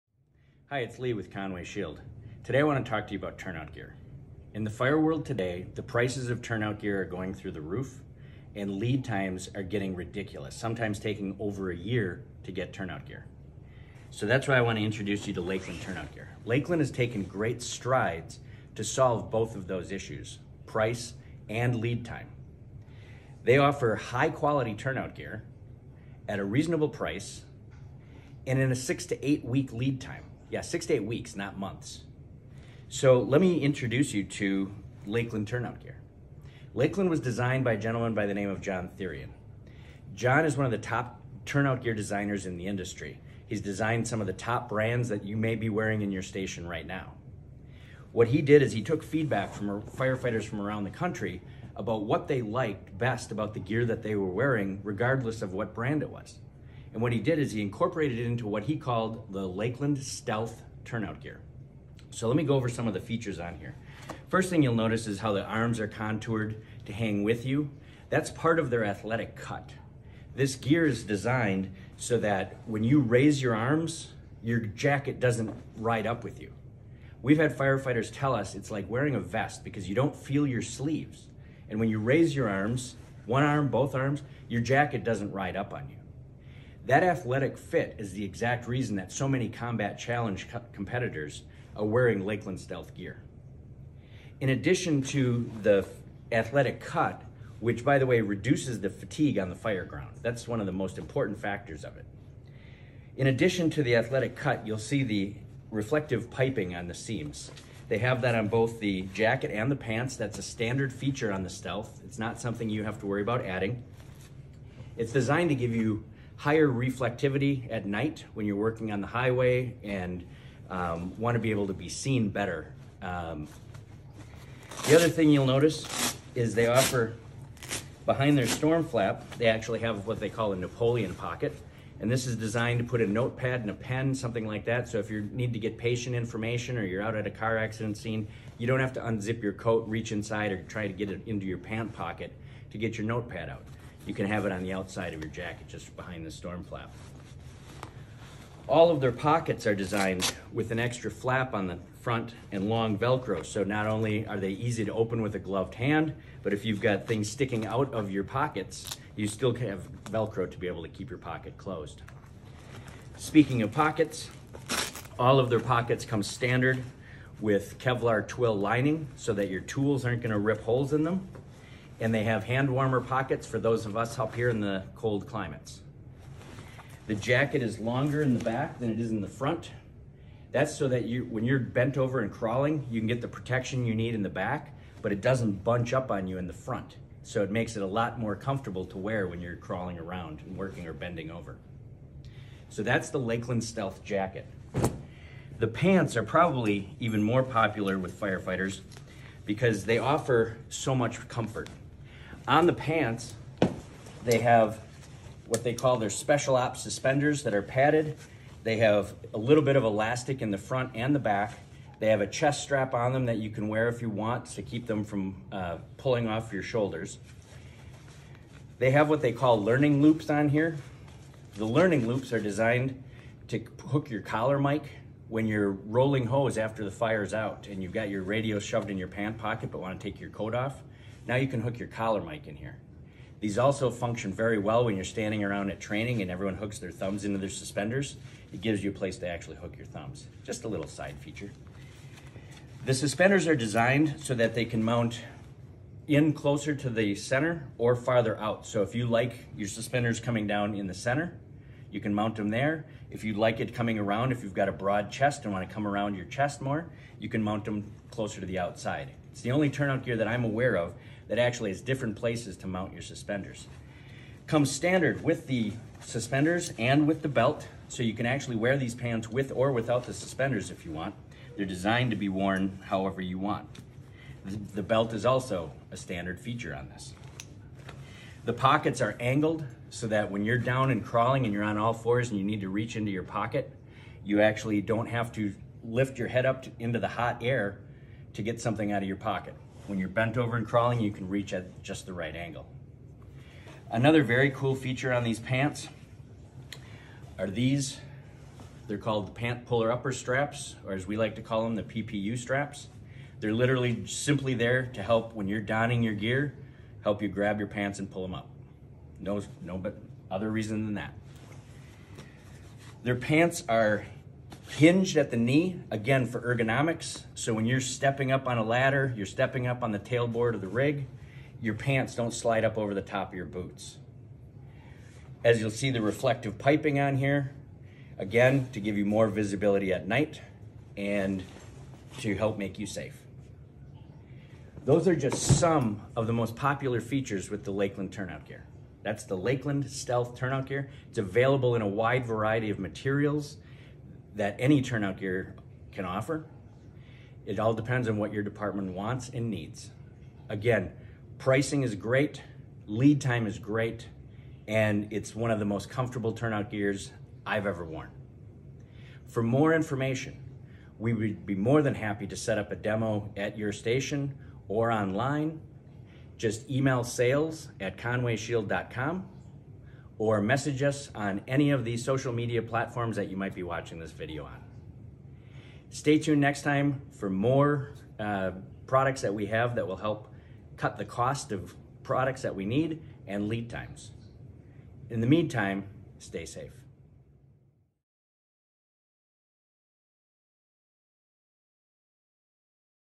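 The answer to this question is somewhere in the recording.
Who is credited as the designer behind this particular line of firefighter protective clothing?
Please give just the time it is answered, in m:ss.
0:38.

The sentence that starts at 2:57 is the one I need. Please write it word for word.
The jacket is longer in the back than it is in the front.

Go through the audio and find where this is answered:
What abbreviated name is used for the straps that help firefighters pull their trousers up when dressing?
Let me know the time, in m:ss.
5:01.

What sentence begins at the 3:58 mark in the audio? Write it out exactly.
It gives you a place to actually hook your thumbs.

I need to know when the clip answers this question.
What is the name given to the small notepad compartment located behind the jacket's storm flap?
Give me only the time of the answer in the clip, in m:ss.
2:10.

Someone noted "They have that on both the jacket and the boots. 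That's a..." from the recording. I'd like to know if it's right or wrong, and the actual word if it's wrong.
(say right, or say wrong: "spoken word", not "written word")
wrong: "pants", not "boots".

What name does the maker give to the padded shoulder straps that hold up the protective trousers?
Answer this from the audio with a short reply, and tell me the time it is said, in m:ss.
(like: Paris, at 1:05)
special ops suspenders, at 3:26.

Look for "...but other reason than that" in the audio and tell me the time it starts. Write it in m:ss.
5:09.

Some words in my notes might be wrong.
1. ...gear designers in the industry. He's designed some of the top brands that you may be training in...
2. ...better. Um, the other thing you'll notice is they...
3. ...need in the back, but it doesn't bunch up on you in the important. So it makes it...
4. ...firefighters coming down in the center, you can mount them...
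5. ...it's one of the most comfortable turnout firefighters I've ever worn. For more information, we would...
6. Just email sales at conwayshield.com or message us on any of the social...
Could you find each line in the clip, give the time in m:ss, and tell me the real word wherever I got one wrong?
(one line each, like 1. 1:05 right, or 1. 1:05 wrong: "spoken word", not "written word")
1. 0:41 wrong: "wearing", not "training"
2. 2:02 right
3. 3:03 wrong: "front", not "important"
4. 4:09 wrong: "suspenders", not "firefighters"
5. 5:55 wrong: "gears", not "firefighters"
6. 6:06 right.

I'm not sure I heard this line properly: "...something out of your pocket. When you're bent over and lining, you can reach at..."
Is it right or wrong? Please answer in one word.
wrong.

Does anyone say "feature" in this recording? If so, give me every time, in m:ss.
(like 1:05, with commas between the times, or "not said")
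1:02, 1:50, 4:01, 4:36, 4:54, 5:37.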